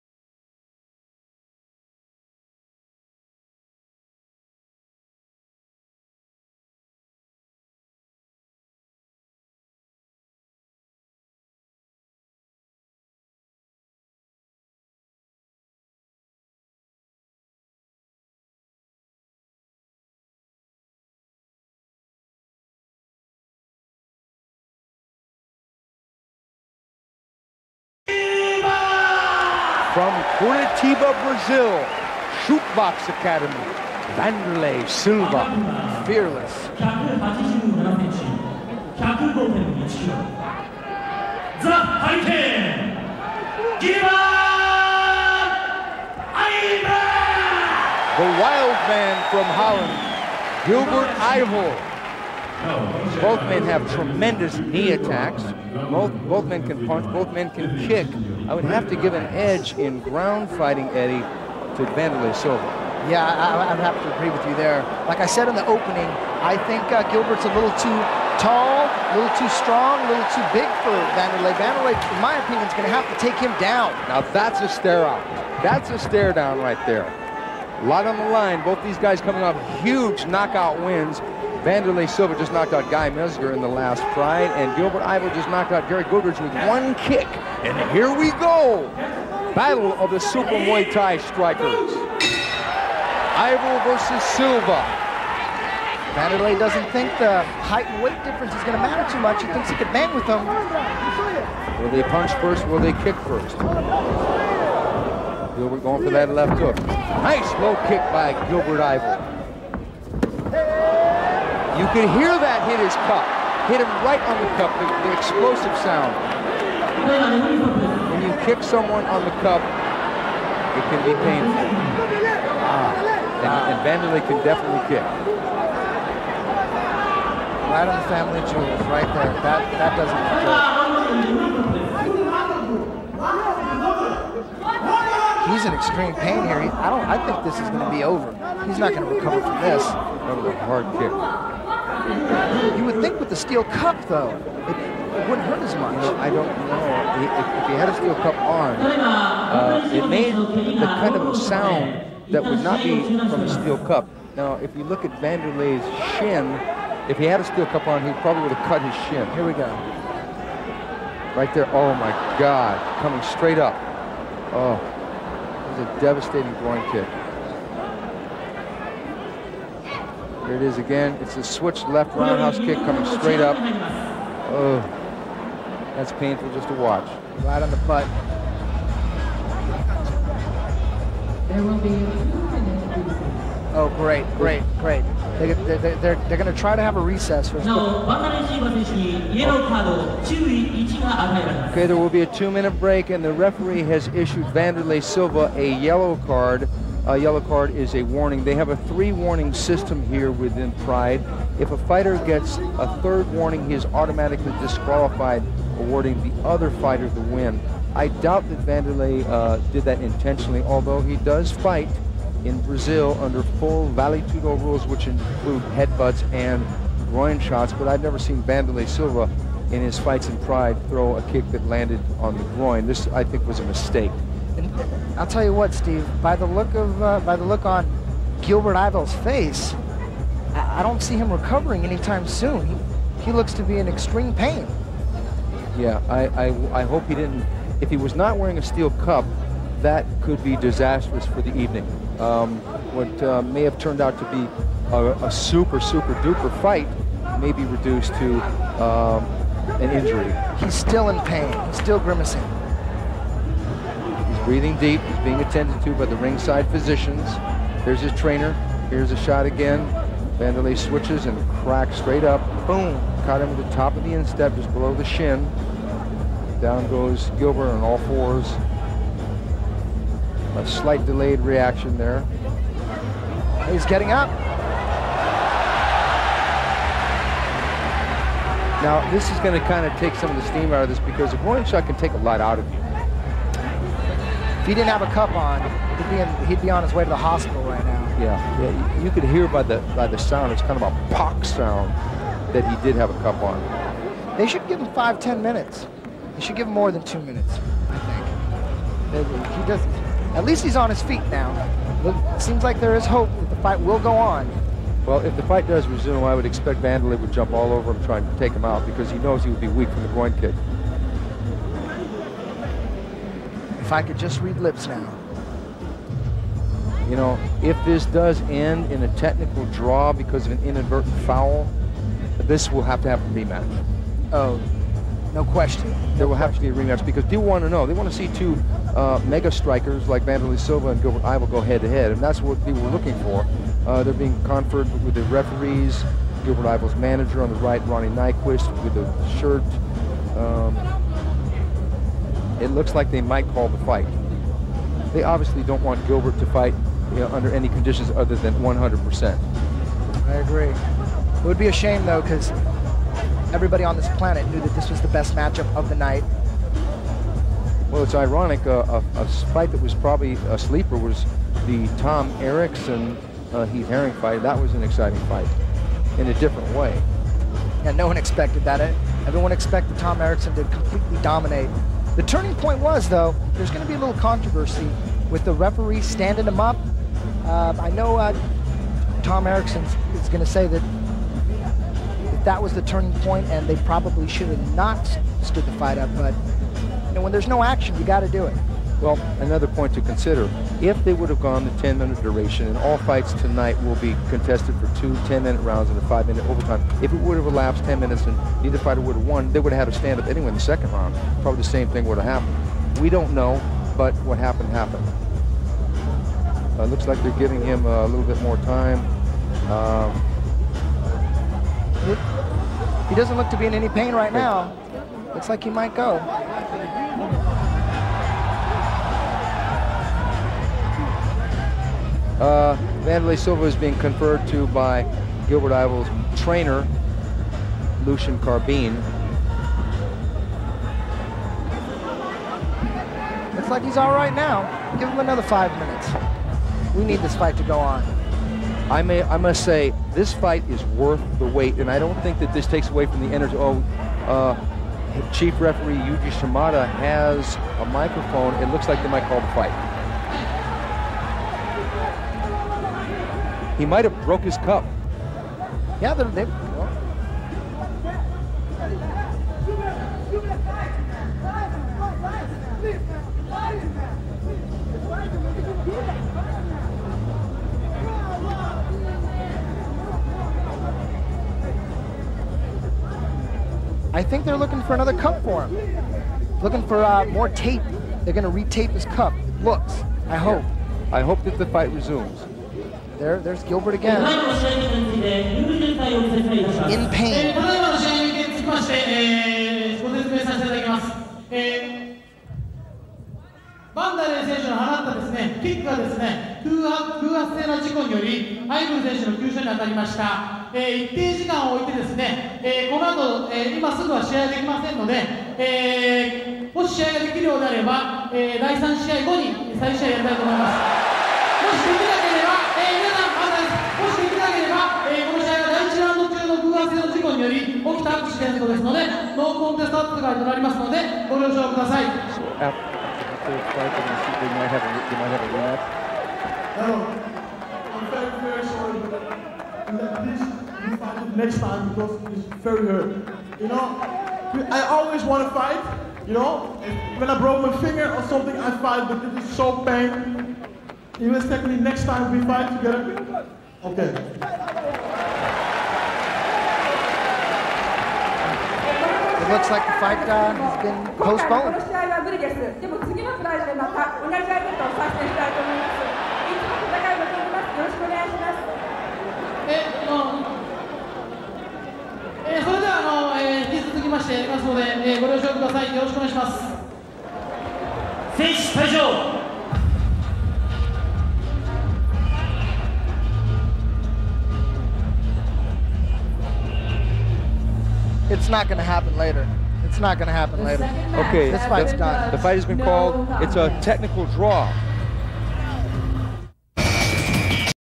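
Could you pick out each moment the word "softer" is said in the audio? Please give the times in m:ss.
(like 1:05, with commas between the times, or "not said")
not said.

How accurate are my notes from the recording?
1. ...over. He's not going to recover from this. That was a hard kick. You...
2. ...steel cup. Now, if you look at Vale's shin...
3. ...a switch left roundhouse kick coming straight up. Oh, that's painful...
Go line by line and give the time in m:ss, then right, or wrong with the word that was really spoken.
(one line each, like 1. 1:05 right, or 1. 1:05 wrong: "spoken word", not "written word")
1. 2:18 right
2. 2:33 wrong: "Wanderlei", not "Vale"
3. 2:51 right.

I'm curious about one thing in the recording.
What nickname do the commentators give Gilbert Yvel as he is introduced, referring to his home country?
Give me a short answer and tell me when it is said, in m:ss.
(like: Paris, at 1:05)
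The wild man from Holland, at 0:48.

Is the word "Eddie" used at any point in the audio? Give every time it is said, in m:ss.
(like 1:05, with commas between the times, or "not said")
1:00.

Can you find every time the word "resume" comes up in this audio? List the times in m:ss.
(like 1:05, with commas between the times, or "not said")
5:05, 8:01.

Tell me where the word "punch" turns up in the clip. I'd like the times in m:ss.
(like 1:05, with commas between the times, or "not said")
0:56, 1:42.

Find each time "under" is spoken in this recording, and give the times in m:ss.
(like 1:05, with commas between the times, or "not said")
3:33, 5:47.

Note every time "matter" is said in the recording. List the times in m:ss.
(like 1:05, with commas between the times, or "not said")
1:38, 2:10.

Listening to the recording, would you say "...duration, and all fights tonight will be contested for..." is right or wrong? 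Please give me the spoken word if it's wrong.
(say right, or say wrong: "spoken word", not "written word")
right.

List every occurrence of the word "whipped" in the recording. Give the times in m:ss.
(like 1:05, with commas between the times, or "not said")
not said.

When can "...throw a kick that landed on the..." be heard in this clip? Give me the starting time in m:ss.
3:40.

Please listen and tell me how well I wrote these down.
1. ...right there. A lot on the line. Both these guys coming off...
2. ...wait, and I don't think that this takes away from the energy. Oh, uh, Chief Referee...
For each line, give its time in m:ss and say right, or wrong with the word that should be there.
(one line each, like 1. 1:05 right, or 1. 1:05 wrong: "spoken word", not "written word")
1. 1:16 right
2. 7:21 right.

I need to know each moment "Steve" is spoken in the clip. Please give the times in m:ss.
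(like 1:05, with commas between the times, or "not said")
3:45.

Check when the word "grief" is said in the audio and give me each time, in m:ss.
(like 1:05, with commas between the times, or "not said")
not said.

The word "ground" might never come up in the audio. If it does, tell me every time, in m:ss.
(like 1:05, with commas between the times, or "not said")
1:00.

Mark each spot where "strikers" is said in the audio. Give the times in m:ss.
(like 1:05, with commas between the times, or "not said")
1:31, 5:29.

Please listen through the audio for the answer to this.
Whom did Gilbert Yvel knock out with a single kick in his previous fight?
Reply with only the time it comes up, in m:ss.
1:25.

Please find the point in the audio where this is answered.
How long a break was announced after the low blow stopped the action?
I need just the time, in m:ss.
3:12.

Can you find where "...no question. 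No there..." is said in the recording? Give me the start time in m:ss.
5:25.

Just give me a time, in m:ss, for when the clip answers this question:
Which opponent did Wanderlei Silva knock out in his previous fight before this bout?
1:22.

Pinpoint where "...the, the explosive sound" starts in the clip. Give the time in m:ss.
1:54.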